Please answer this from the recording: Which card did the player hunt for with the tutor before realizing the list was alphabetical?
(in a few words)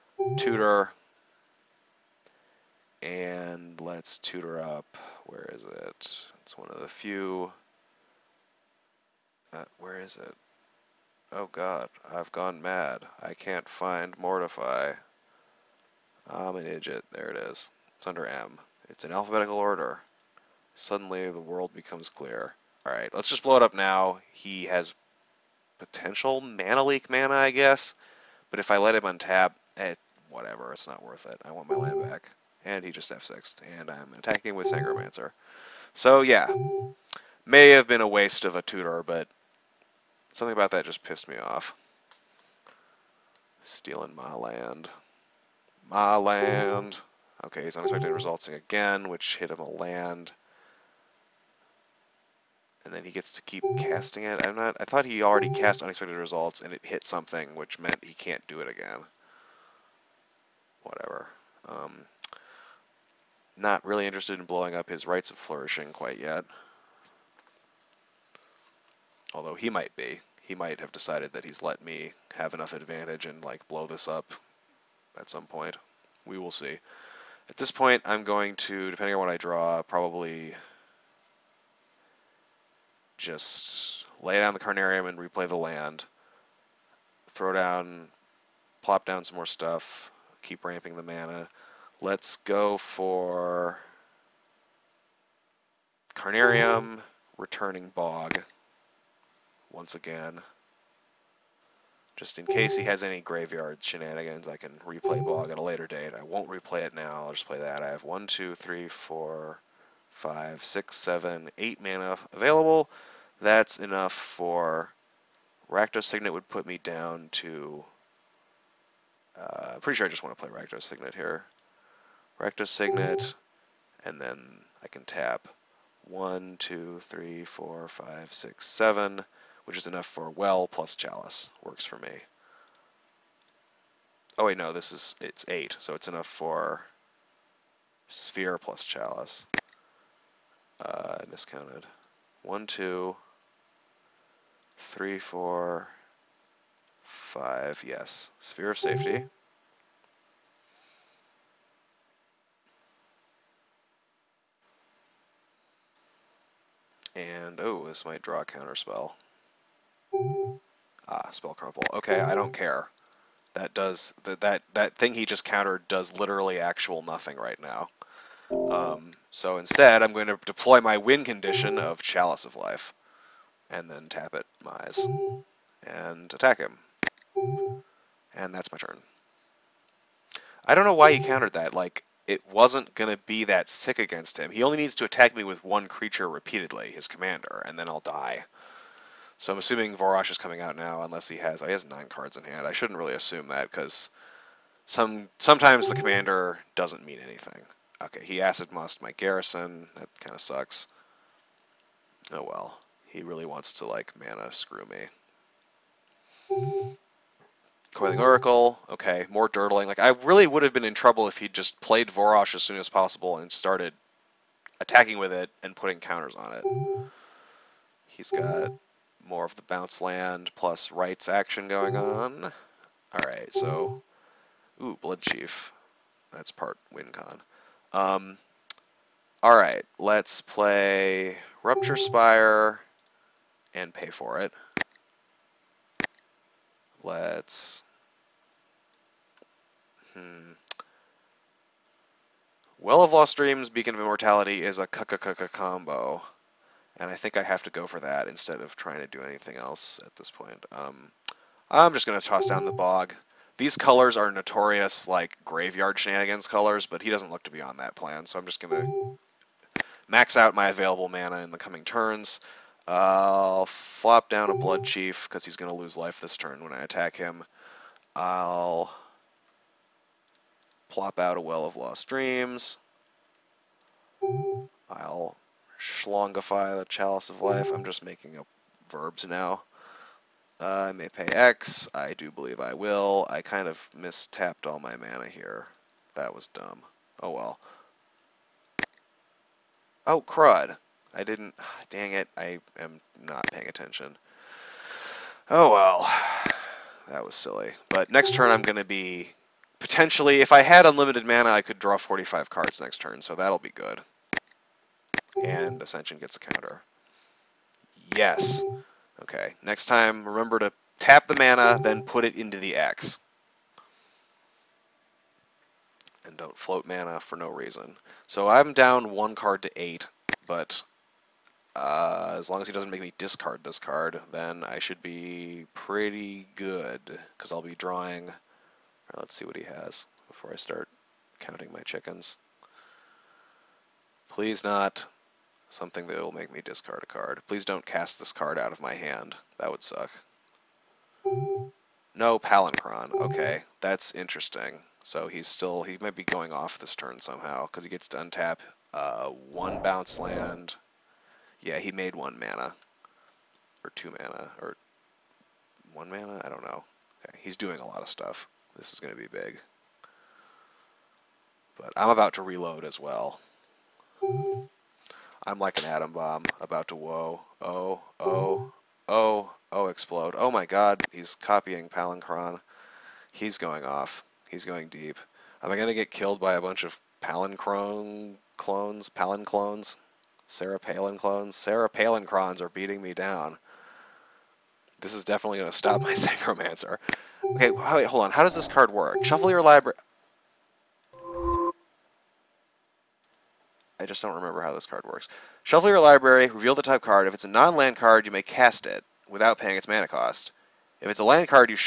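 Mortify.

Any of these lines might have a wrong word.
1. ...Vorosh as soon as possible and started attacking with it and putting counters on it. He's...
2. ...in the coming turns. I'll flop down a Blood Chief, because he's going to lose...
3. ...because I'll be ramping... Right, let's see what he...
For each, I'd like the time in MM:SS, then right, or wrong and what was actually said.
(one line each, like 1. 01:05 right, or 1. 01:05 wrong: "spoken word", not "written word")
1. 03:32 right
2. 04:21 right
3. 05:27 wrong: "drawing", not "ramping".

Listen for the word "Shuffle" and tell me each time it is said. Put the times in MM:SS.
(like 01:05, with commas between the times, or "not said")
06:29, 06:35.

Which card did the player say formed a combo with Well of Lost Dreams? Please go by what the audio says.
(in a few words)
Beacon of Immortality.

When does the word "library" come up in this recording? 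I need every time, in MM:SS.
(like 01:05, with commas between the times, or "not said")
06:29, 06:35.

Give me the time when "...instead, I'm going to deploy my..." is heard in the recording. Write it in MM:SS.
02:49.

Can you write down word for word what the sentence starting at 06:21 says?
Sarah Palincrons are beating me down.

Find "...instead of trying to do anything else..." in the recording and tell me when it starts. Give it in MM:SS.
04:08.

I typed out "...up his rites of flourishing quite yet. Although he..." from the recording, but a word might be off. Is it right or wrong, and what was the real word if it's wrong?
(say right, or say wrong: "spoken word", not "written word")
right.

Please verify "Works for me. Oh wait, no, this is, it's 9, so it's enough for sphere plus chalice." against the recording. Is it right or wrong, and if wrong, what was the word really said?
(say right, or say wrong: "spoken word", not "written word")
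wrong: "8", not "9".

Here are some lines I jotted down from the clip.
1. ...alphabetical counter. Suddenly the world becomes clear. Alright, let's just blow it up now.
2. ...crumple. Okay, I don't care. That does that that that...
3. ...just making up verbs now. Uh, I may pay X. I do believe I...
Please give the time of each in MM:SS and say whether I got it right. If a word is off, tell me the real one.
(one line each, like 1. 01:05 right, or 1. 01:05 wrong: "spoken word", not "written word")
1. 00:19 wrong: "order", not "counter"
2. 02:41 right
3. 04:37 right.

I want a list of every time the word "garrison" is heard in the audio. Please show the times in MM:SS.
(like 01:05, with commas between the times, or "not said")
03:19.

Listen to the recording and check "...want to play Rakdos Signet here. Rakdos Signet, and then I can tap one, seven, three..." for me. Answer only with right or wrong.
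wrong.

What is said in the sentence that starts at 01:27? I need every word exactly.
Throw down, plop down some more stuff, keep ramping the mana.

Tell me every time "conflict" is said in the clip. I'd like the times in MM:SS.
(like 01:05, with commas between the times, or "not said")
not said.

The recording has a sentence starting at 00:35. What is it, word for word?
So yeah, may have been a waste of a tutor, but something about that just pissed me off.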